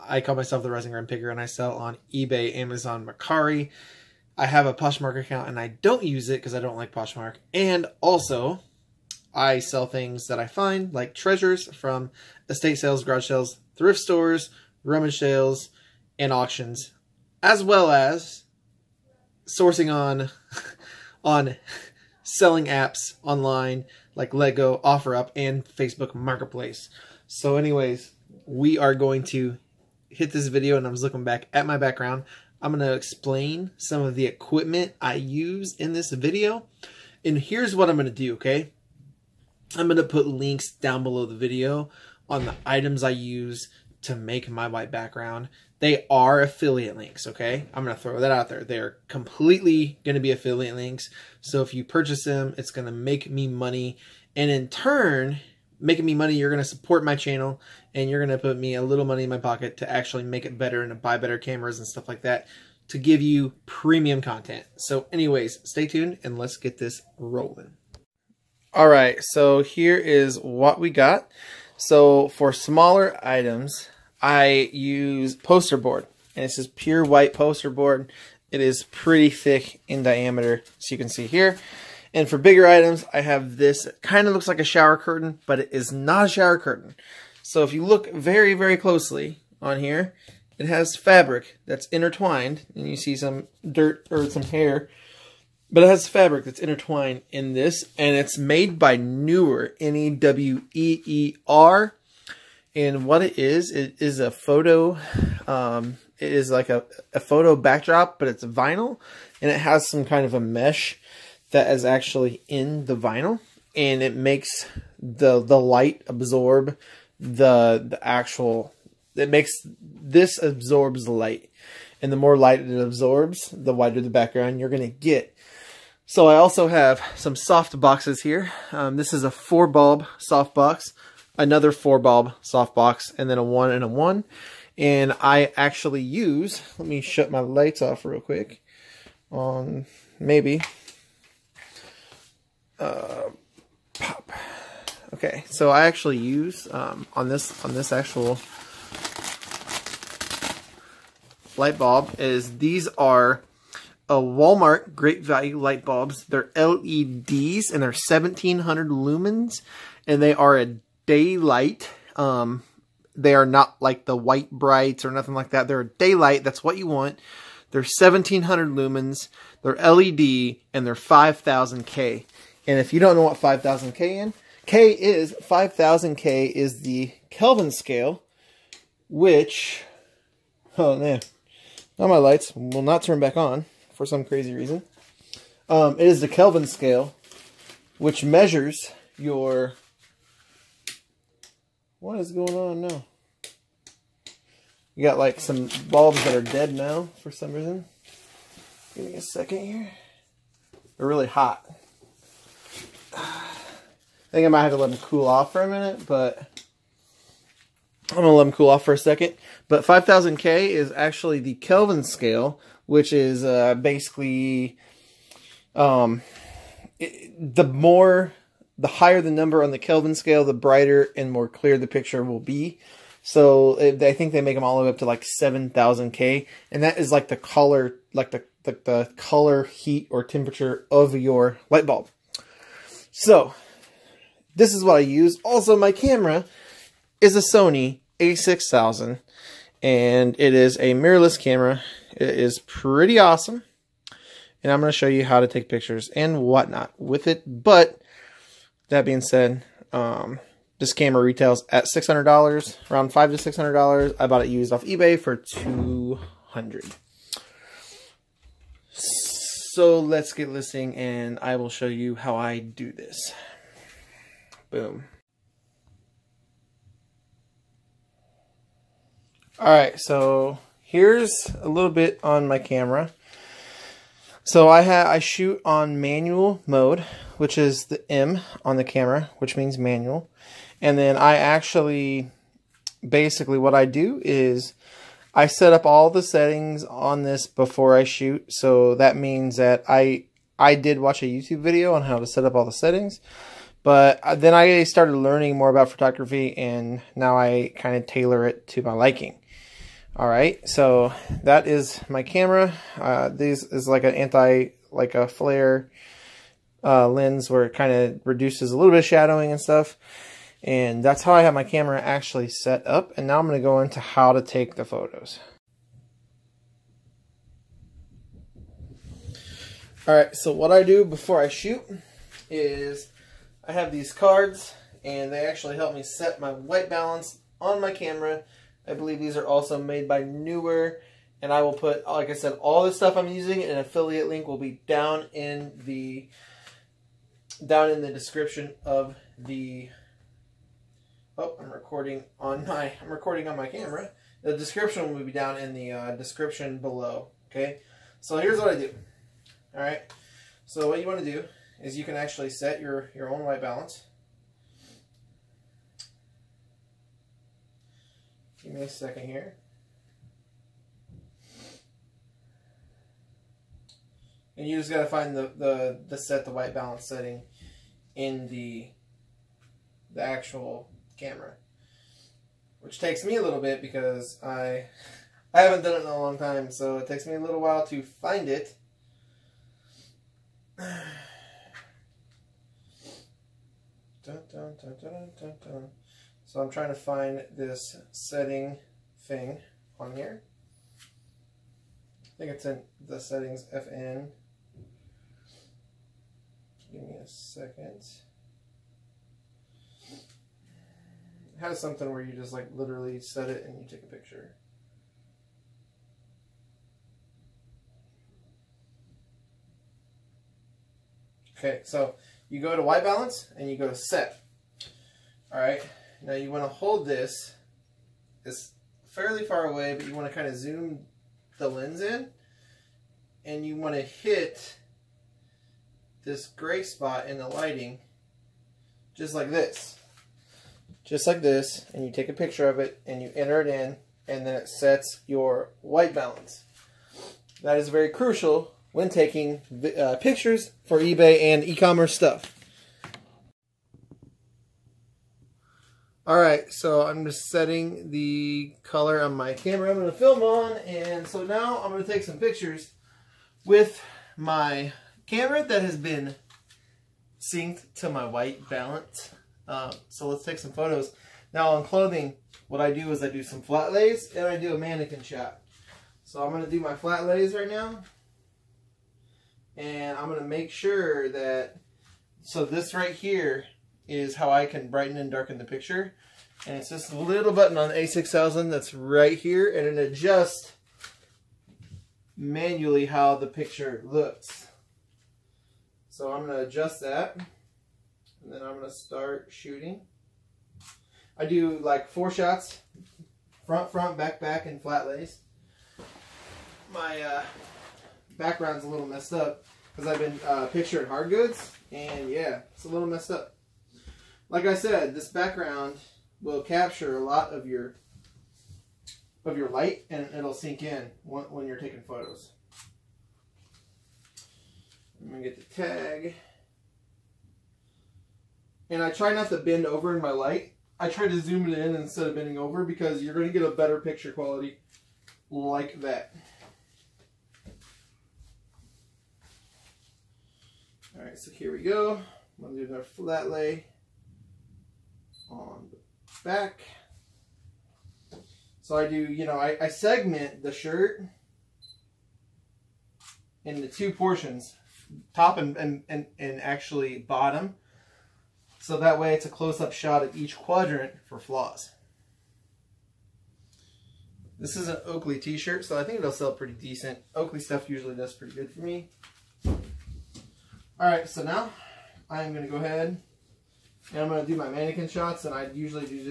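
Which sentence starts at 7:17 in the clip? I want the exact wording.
That is very crucial when taking uh, pictures for eBay and e-commerce stuff.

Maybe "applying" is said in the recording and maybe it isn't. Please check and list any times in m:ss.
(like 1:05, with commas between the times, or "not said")
not said.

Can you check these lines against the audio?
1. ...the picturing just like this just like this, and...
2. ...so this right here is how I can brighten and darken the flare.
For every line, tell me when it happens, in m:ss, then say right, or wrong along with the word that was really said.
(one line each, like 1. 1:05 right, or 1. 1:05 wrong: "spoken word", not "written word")
1. 7:07 wrong: "lighting", not "picturing"
2. 7:52 wrong: "picture", not "flare".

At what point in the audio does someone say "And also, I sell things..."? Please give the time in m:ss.
0:07.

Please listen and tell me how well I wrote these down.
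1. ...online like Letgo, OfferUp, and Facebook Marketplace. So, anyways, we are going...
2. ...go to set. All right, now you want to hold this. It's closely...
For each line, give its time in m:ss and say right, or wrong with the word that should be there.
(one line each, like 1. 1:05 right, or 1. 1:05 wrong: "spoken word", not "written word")
1. 0:23 right
2. 6:53 wrong: "fairly", not "closely".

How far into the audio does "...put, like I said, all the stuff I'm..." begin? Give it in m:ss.
5:31.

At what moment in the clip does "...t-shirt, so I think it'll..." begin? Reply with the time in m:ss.
9:15.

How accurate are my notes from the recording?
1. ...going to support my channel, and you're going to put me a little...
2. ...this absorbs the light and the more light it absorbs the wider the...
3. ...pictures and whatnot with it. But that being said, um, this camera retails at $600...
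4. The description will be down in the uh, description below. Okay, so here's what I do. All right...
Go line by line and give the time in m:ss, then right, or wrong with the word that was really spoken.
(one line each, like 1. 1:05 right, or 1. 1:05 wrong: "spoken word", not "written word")
1. 0:56 right
2. 1:59 right
3. 4:05 right
4. 5:44 right.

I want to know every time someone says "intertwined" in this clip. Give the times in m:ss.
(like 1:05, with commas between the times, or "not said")
1:31, 1:36.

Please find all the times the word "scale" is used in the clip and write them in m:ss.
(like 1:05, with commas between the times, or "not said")
2:57, 3:06, 3:32, 3:40.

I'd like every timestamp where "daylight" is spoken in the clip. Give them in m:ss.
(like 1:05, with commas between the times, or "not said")
2:41, 2:45.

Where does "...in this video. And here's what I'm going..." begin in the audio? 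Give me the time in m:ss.
0:35.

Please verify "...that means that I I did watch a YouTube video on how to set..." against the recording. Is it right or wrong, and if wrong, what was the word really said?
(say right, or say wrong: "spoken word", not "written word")
right.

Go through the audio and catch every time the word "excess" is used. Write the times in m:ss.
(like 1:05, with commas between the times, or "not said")
not said.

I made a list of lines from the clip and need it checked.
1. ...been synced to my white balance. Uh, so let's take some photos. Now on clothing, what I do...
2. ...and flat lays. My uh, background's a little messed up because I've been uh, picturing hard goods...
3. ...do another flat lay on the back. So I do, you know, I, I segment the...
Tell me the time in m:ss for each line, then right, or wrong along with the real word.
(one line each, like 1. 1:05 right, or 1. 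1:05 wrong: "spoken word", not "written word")
1. 7:35 right
2. 8:14 right
3. 8:52 right.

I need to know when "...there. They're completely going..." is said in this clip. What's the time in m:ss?
0:48.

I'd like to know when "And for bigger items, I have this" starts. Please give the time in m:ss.
1:22.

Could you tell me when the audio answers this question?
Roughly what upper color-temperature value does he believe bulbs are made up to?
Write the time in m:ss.
3:45.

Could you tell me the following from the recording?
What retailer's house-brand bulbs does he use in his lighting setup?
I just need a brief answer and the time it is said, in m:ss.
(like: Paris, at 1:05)
Walmart, at 2:34.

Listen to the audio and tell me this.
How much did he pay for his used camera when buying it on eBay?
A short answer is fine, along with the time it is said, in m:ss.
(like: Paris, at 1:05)
$200, at 4:15.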